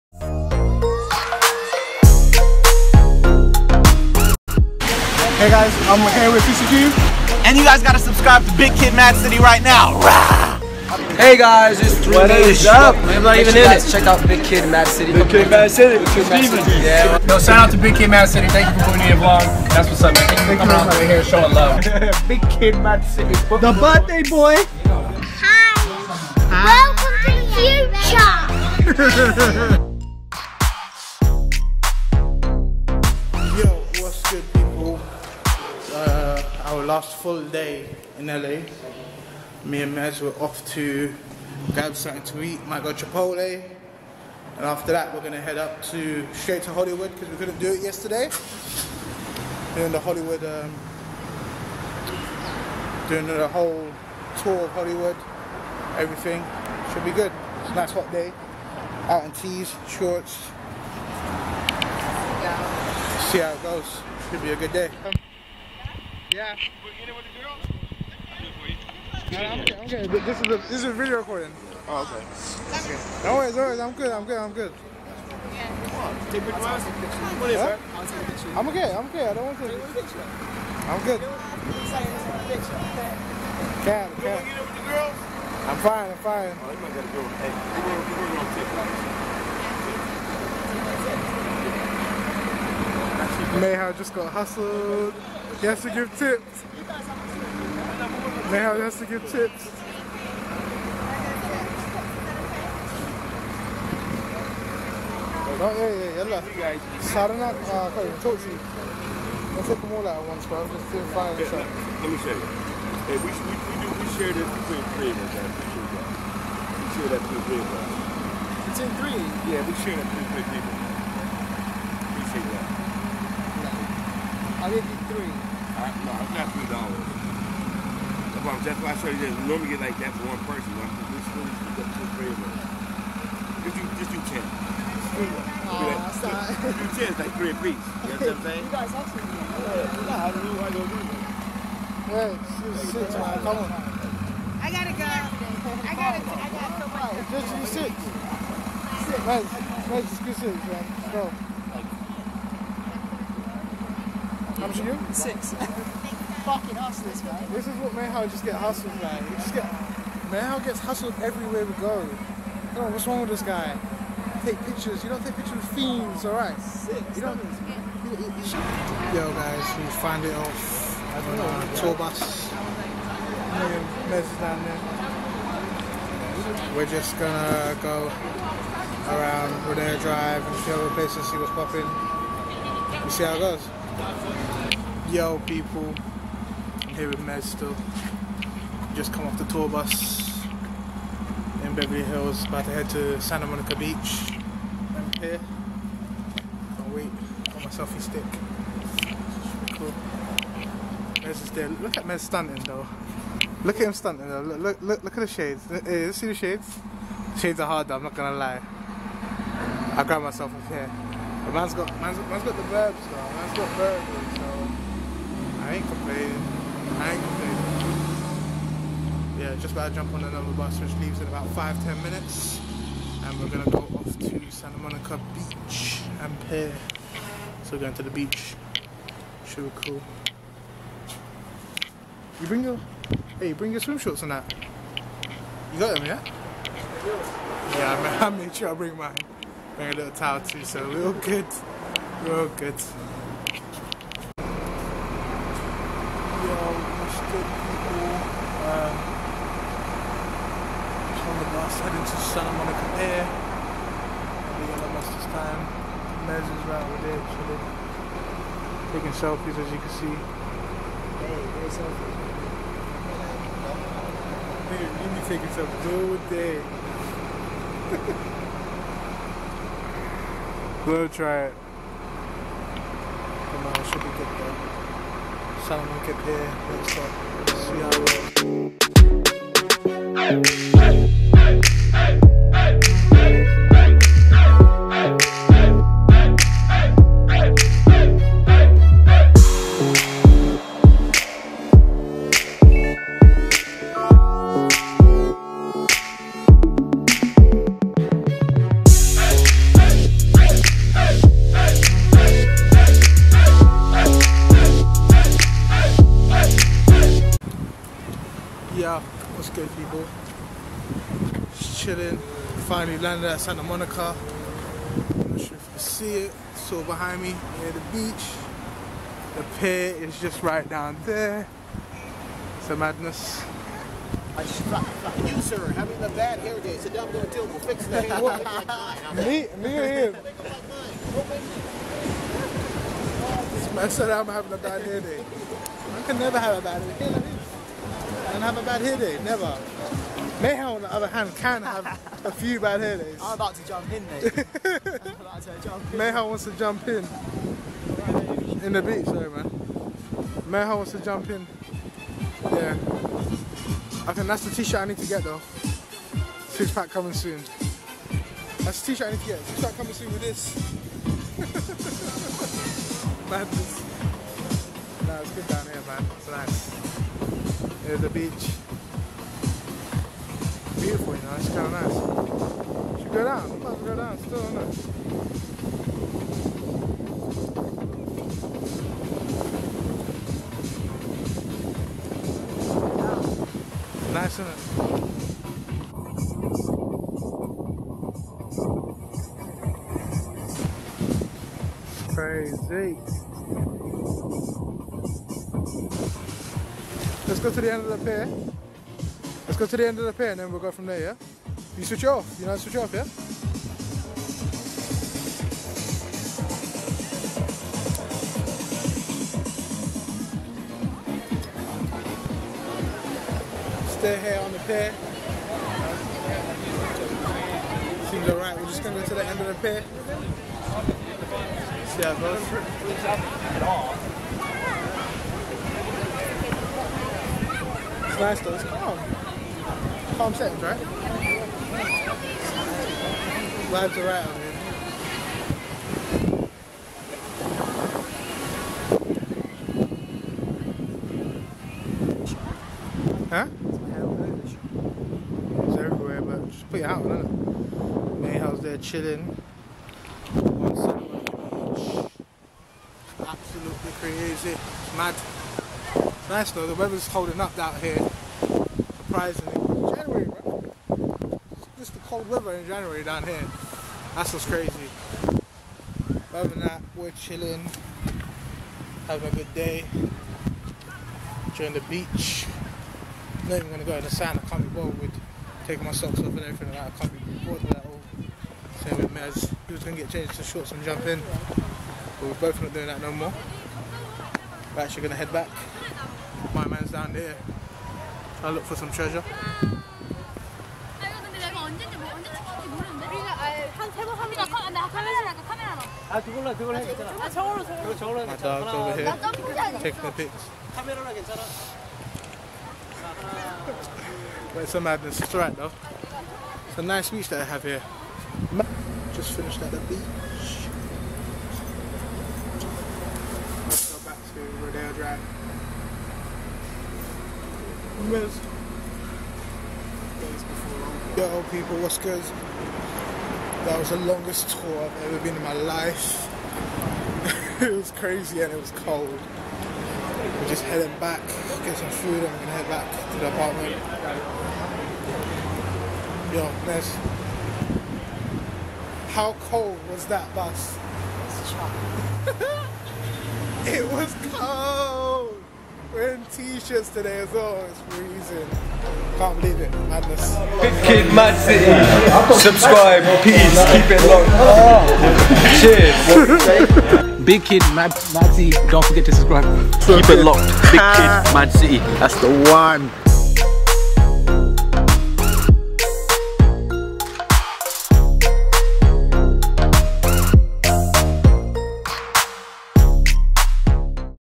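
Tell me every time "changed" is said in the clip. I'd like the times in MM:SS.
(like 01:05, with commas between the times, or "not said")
08:00.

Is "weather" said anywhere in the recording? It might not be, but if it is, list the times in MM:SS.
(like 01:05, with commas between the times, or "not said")
07:36, 07:42.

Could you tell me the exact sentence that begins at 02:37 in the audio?
This is what Mayhow just get hustled, man.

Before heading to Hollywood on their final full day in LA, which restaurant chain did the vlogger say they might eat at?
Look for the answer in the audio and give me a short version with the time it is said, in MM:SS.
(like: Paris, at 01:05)
Chipotle, at 00:42.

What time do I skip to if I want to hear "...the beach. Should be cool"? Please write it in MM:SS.
03:48.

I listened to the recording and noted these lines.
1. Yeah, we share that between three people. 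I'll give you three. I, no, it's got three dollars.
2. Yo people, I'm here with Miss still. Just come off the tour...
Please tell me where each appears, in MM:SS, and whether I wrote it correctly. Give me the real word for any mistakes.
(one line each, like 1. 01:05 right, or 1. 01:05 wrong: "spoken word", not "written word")
1. 01:59 right
2. 03:05 wrong: "Mez", not "Miss".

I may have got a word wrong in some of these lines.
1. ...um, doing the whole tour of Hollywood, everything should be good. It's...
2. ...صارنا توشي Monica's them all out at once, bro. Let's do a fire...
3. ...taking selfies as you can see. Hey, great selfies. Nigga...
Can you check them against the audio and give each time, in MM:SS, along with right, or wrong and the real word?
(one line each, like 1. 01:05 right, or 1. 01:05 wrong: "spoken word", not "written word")
1. 00:50 right
2. 01:47 wrong: "Let", not "Monica"
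3. 04:18 right.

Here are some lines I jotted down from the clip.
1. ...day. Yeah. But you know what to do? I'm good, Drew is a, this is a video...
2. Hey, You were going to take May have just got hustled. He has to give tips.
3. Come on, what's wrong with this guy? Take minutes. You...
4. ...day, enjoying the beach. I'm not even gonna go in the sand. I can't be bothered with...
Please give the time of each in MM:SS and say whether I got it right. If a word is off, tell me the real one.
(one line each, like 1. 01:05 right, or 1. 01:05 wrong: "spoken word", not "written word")
1. 01:04 wrong: "This", not "Drew"
2. 01:27 right
3. 02:42 wrong: "pictures", not "minutes"
4. 07:49 right.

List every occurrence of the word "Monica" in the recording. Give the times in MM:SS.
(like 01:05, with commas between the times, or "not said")
03:13, 03:44, 04:12, 05:13.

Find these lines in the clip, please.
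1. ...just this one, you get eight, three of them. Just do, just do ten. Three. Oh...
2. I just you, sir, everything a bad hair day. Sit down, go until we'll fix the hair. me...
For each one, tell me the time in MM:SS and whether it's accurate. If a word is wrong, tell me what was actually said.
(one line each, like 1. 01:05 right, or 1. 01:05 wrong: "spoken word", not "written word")
1. 02:11 wrong: "two", not "eight"
2. 05:24 wrong: "having", not "everything".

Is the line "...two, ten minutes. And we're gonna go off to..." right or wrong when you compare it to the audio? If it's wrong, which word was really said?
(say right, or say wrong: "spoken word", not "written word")
wrong: "five", not "two".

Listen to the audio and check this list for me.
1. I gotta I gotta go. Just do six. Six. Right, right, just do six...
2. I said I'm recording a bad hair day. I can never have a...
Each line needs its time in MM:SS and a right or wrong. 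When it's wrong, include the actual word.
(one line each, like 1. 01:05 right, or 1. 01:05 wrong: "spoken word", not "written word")
1. 02:25 right
2. 05:33 wrong: "having", not "recording".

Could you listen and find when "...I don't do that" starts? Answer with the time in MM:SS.
02:20.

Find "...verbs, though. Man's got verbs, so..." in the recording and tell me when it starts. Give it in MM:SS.
03:32.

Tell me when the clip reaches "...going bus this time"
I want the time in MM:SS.
04:14.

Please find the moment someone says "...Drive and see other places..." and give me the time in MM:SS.
03:00.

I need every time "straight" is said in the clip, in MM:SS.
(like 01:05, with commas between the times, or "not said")
00:46.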